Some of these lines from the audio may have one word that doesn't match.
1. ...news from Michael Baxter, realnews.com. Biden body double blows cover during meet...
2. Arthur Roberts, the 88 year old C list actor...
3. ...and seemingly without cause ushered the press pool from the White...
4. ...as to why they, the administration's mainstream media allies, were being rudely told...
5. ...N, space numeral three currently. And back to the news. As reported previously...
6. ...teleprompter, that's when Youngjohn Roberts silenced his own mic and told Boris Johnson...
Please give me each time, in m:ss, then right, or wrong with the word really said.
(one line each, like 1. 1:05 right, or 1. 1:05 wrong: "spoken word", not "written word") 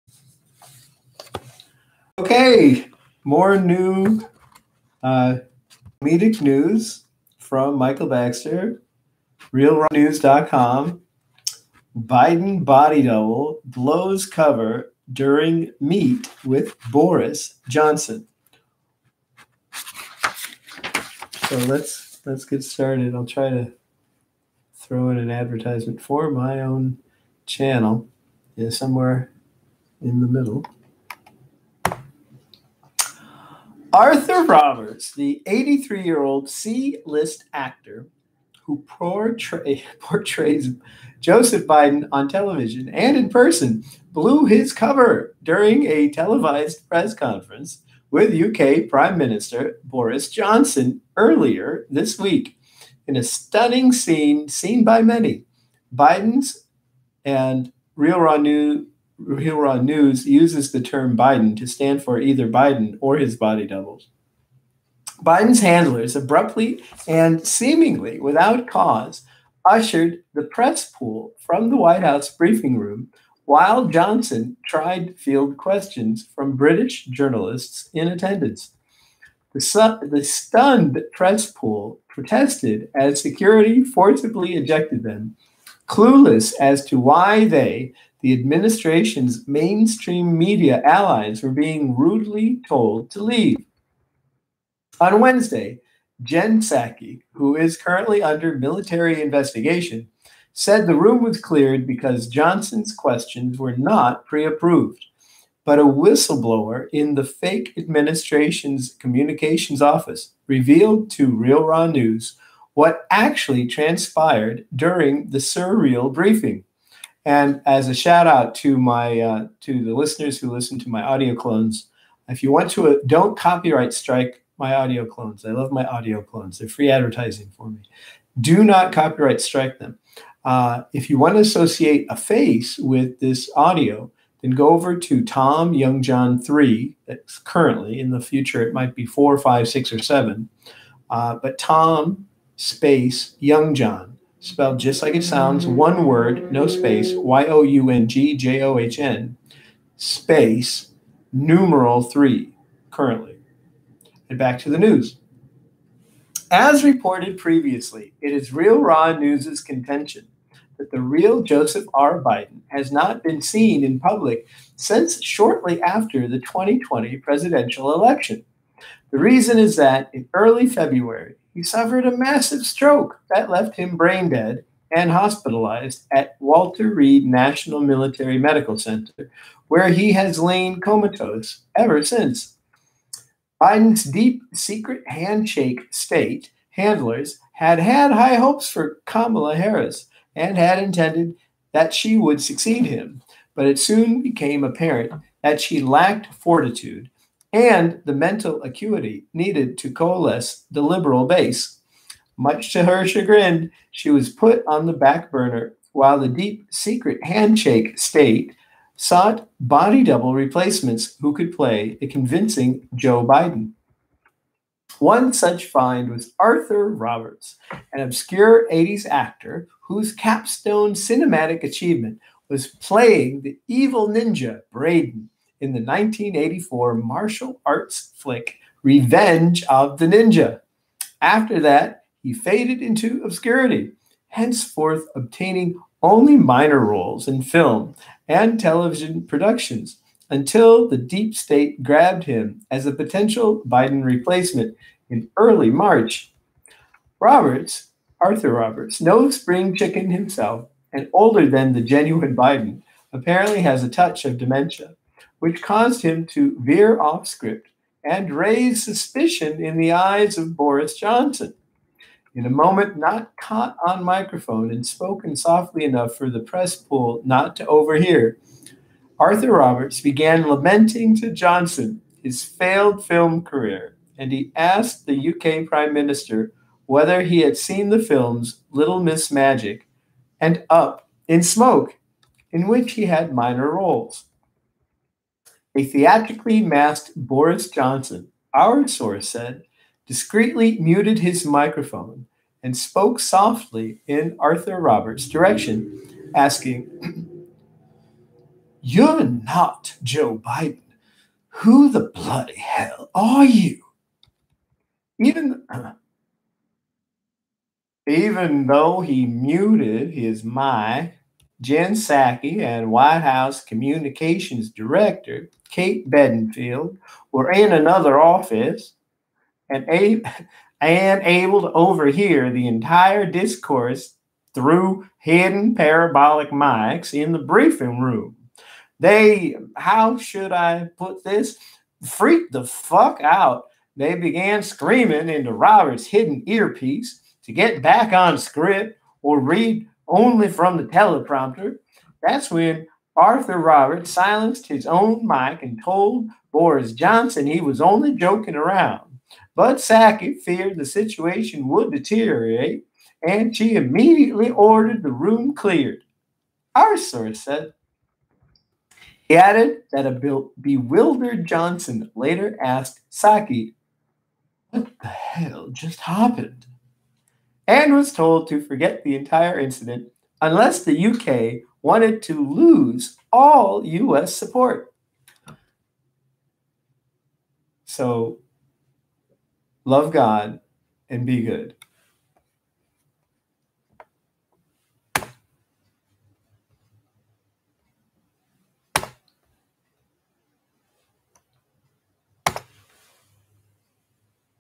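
1. 0:06 right
2. 0:34 wrong: "83", not "88"
3. 1:07 right
4. 1:26 right
5. 2:28 right
6. 5:40 wrong: "Arthur", not "Youngjohn".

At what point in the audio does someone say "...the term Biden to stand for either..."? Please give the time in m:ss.
1:00.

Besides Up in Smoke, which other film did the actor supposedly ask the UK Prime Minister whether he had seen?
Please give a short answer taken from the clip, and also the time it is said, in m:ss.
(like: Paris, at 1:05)
Little Miss Magic, at 4:38.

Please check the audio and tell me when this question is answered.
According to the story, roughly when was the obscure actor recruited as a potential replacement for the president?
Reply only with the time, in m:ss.
4:05.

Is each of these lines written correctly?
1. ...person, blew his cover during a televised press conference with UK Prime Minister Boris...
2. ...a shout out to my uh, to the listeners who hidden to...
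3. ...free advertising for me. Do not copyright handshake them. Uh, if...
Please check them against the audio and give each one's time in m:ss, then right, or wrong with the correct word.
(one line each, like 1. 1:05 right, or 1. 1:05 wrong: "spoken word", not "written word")
1. 0:43 right
2. 1:57 wrong: "listen", not "hidden"
3. 2:06 wrong: "strike", not "handshake".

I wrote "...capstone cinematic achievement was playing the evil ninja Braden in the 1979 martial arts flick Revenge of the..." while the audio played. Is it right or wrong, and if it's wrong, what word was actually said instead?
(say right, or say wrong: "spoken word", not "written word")
wrong: "1984", not "1979".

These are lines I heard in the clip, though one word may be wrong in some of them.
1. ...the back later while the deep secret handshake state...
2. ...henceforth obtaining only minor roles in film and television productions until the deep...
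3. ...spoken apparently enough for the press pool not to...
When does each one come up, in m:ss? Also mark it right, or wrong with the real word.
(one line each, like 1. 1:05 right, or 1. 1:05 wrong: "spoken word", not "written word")
1. 3:24 wrong: "burner", not "later"
2. 3:54 right
3. 4:24 wrong: "softly", not "apparently".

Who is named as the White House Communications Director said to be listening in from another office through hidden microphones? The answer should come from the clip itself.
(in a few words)
Kate Bedingfield.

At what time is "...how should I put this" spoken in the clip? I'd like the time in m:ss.
5:29.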